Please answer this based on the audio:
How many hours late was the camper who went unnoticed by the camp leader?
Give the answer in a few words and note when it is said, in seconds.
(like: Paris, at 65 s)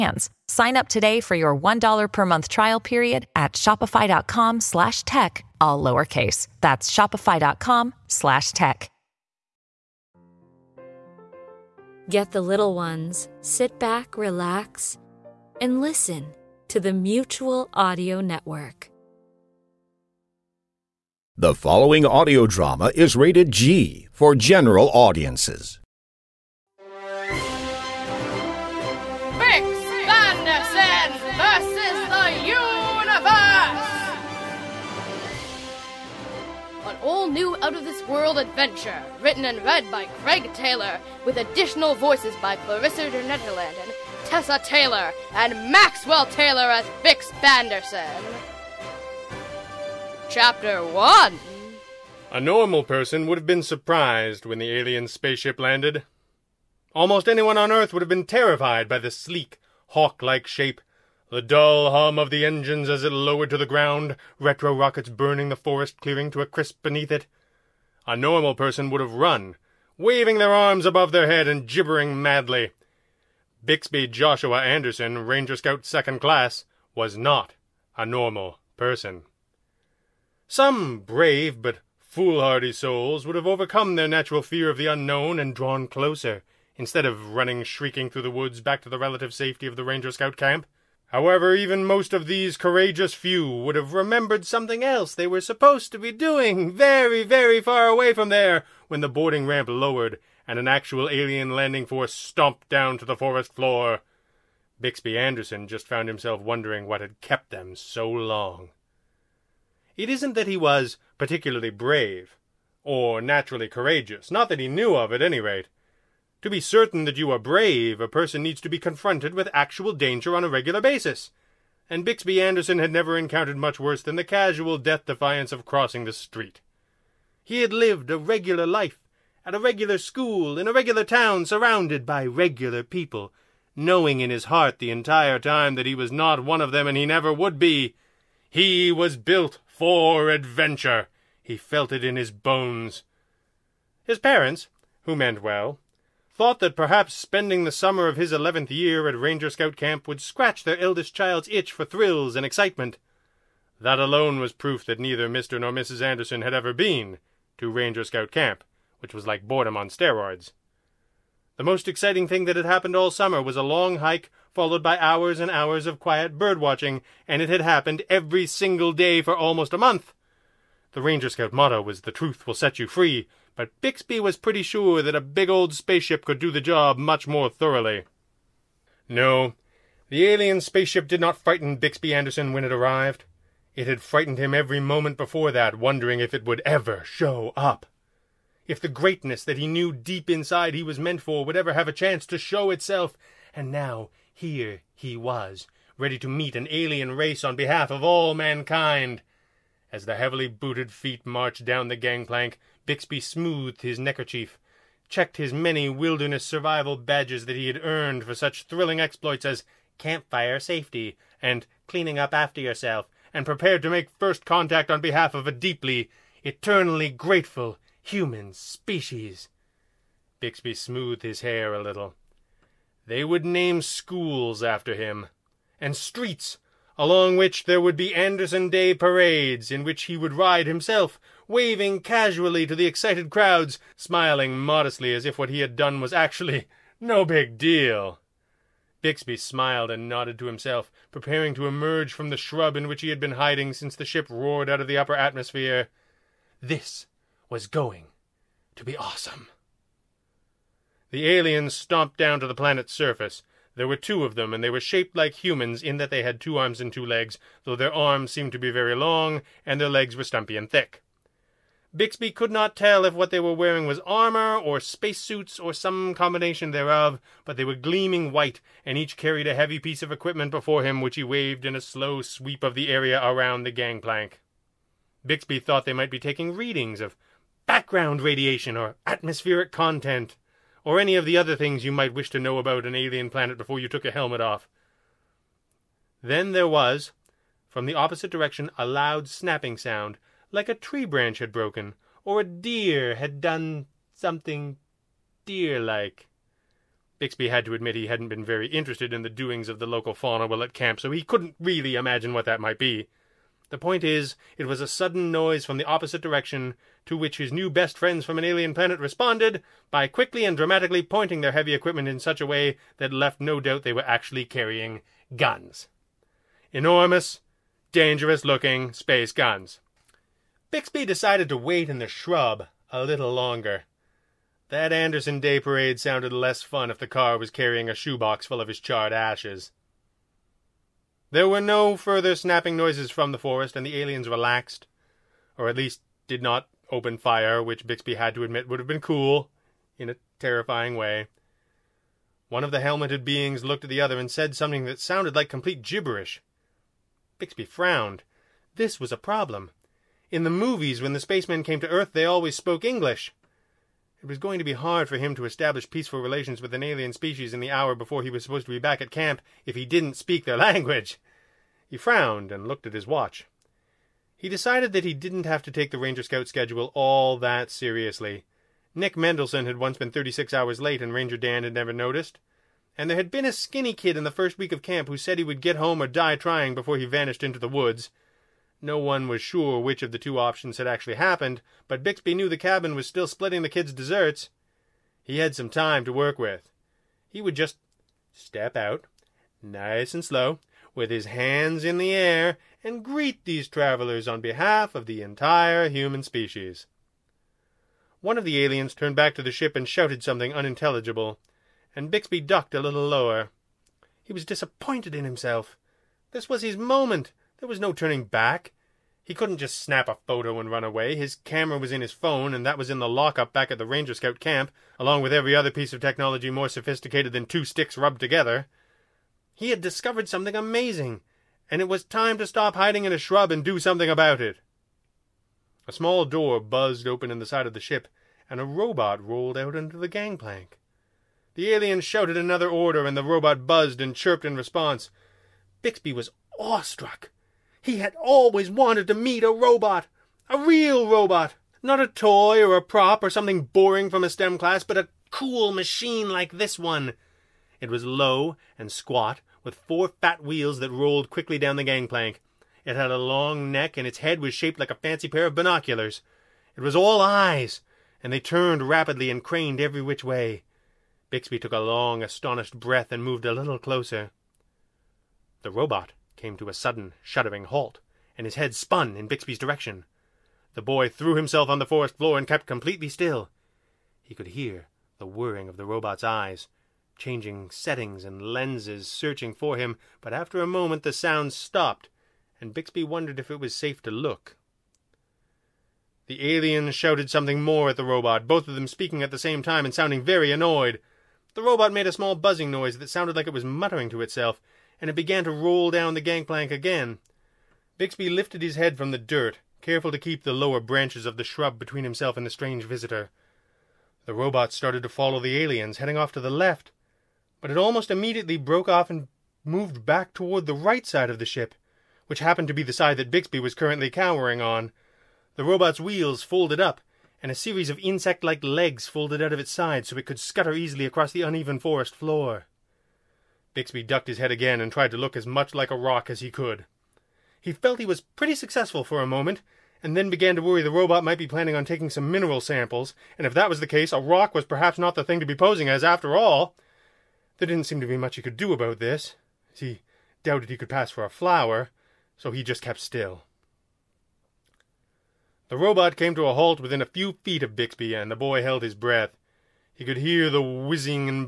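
36, at 370 s.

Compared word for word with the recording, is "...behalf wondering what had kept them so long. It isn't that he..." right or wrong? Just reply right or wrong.
wrong.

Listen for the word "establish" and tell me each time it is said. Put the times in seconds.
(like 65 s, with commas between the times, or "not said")
355 s.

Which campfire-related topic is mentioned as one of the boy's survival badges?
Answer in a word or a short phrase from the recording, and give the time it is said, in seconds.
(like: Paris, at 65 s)
campfire safety, at 209 s.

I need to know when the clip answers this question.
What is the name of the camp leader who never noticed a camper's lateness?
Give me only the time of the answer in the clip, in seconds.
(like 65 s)
371 s.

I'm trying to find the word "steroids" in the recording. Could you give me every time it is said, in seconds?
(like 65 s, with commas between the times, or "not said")
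159 s.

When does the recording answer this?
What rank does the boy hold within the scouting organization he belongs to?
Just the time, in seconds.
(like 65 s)
75 s.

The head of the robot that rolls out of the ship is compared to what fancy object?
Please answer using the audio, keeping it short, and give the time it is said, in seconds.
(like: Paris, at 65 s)
binoculars, at 455 s.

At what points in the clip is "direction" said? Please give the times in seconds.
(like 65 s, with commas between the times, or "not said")
288 s, 306 s, 469 s.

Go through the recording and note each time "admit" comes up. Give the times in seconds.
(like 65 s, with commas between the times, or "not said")
297 s, 338 s.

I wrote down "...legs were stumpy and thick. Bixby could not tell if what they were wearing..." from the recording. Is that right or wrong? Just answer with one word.
right.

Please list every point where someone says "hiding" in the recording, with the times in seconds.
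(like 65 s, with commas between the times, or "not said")
243 s, 422 s.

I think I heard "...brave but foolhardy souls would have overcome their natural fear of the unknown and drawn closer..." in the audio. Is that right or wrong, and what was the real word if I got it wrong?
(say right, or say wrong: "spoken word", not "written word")
right.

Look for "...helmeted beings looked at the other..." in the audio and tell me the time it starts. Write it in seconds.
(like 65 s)
342 s.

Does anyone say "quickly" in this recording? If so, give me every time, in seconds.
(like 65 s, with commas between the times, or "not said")
310 s, 451 s.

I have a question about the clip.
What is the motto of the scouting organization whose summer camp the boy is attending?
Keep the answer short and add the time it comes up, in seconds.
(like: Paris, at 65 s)
The Truth Will Set You Free, at 172 s.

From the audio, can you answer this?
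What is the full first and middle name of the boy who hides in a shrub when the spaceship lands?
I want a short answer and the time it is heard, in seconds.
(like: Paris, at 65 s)
Bixby Joshua, at 73 s.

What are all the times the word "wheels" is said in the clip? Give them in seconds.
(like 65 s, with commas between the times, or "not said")
450 s, 516 s.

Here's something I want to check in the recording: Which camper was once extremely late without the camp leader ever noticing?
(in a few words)
Nick Mendelssohn.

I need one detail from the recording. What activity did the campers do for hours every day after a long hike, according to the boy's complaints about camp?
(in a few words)
bird watching.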